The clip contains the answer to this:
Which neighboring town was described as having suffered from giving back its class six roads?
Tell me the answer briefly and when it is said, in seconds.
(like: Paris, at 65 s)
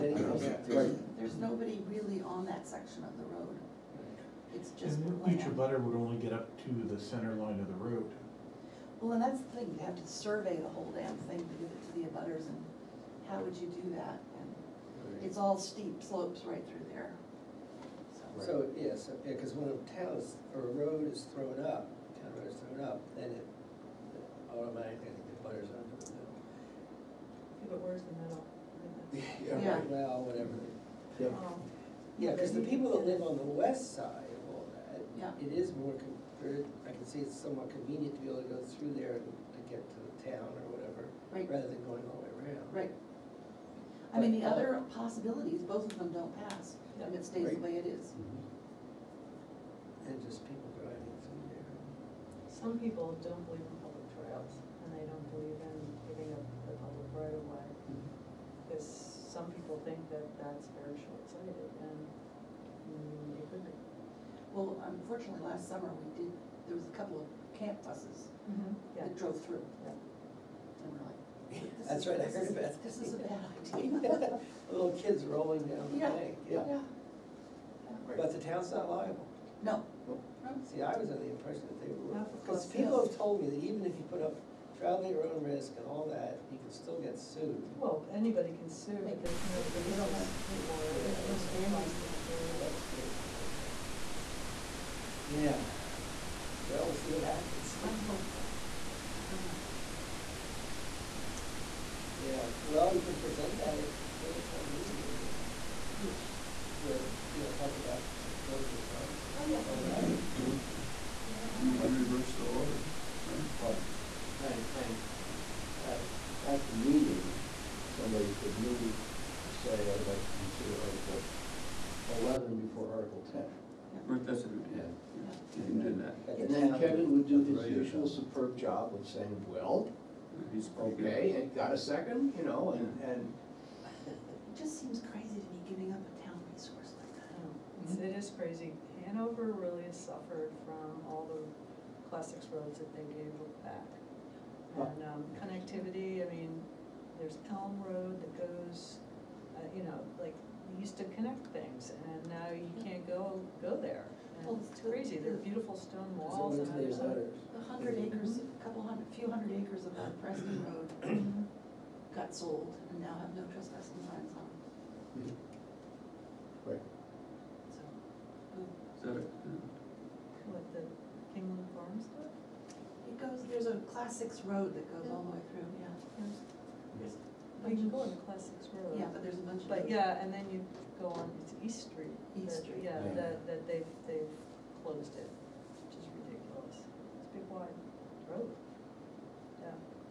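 Hanover, at 139 s.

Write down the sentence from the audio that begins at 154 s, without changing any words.
Well, it's crazy, they're beautiful stone walls there's A hundred acres, a couple hundred, few hundred acres of that Preston mm-hmm.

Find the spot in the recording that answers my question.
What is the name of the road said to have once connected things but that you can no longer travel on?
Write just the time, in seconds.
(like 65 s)
147 s.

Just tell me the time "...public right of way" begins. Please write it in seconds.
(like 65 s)
56 s.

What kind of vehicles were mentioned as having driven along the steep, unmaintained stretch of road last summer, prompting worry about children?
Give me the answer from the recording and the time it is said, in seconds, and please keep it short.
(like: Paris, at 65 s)
camp buses, at 67 s.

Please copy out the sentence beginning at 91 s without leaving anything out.
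there's no standing classic Well, that's great, because I thought, yeah, well, we'll see what happens.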